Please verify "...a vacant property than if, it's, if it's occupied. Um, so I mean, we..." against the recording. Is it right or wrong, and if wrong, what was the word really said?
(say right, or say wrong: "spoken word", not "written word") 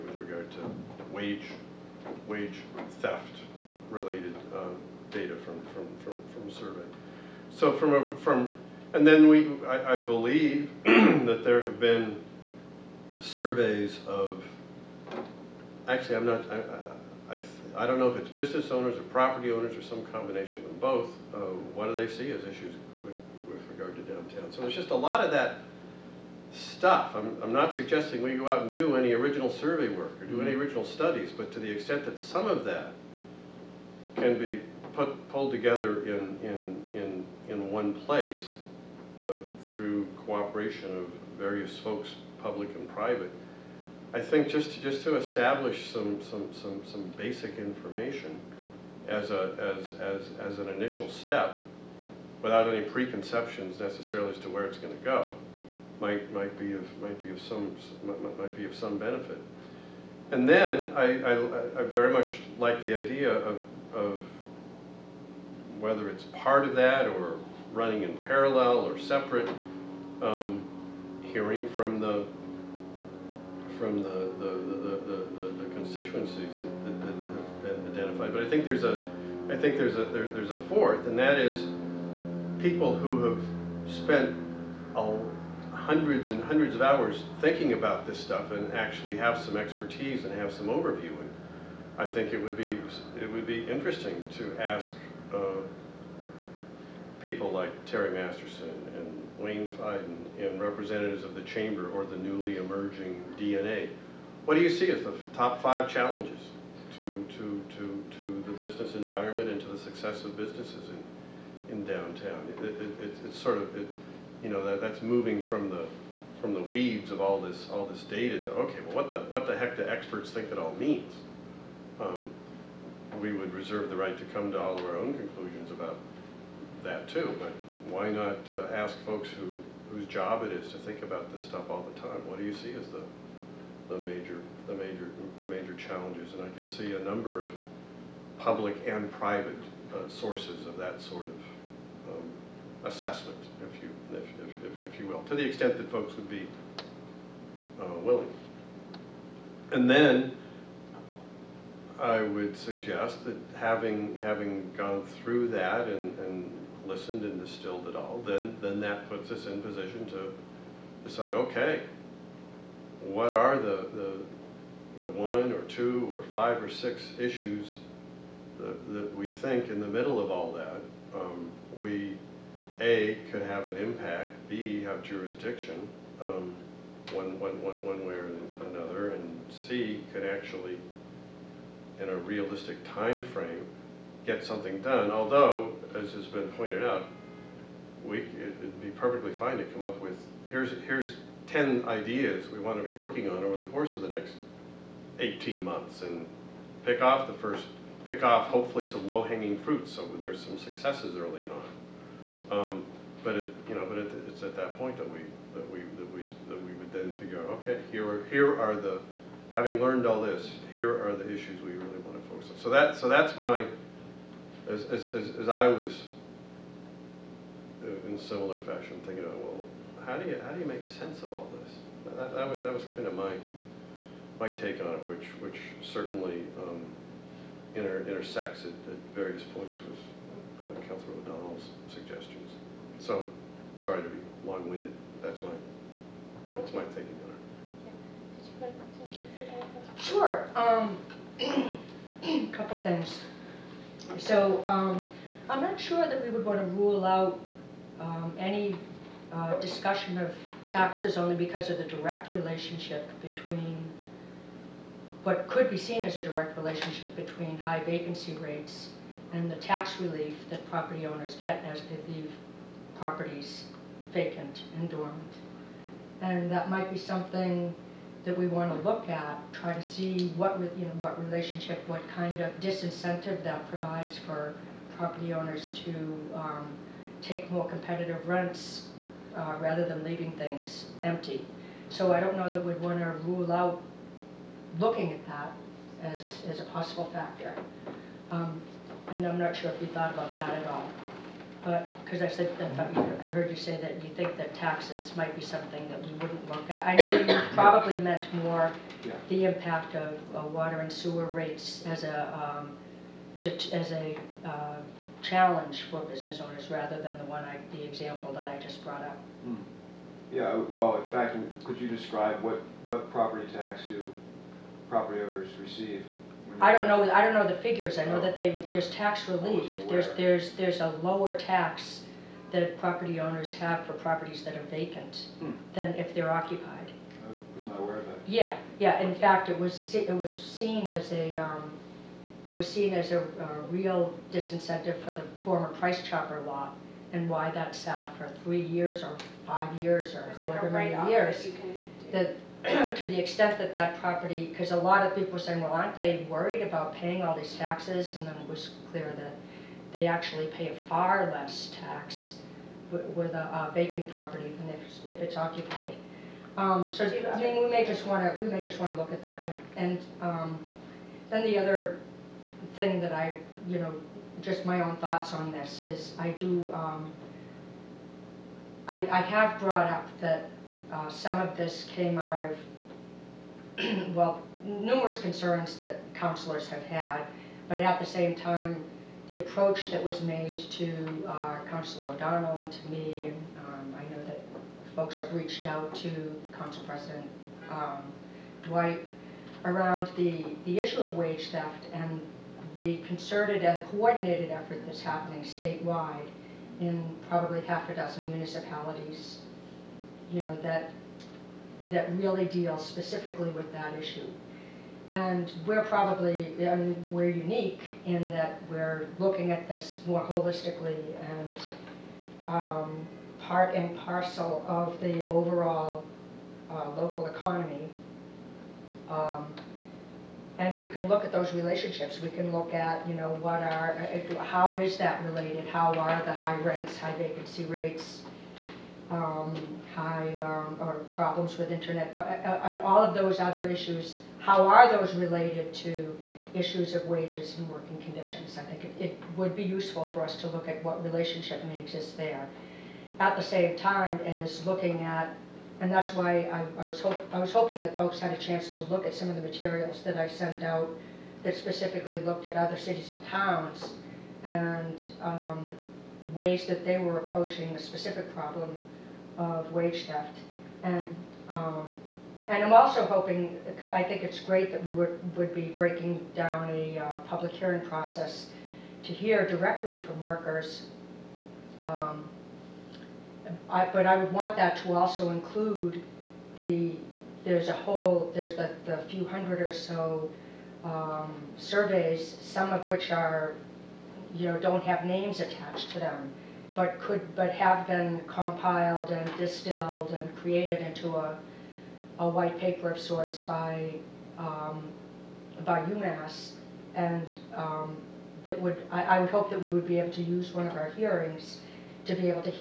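right.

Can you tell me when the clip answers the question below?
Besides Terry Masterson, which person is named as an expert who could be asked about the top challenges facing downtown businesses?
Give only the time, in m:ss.
1:39.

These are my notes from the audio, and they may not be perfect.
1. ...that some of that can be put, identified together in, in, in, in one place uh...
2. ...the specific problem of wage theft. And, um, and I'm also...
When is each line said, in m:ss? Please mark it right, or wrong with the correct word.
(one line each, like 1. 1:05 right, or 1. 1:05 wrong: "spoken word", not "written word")
1. 0:32 wrong: "pulled", not "identified"
2. 7:37 right.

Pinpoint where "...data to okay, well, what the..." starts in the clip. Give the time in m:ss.
1:58.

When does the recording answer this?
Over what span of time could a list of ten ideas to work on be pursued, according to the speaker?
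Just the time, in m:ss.
3:15.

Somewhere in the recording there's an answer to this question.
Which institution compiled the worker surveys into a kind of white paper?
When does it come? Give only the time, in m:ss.
8:15.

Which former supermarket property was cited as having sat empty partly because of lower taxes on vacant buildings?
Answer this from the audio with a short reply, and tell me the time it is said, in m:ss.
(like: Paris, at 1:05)
Price Chopper, at 5:35.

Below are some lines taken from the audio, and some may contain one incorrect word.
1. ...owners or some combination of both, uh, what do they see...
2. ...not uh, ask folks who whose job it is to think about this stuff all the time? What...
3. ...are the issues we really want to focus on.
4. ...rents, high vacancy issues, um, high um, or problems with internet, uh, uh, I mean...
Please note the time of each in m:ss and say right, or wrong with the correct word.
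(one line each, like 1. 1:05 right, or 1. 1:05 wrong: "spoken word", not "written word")
1. 0:19 right
2. 2:08 right
3. 3:31 right
4. 7:06 wrong: "rates", not "issues".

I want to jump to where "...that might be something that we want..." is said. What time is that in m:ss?
4:26.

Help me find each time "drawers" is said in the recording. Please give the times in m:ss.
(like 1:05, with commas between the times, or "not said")
not said.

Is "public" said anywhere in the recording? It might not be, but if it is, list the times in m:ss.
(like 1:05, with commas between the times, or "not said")
0:42, 2:18, 7:47.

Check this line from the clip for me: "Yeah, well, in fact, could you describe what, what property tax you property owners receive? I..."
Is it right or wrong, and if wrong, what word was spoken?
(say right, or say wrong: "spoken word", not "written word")
right.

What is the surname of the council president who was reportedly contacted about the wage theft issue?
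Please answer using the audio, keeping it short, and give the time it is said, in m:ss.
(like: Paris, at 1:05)
Dwight, at 6:28.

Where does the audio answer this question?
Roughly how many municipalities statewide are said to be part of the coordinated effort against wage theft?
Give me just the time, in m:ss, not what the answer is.
6:37.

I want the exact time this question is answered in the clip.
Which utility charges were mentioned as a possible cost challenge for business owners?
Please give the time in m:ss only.
5:00.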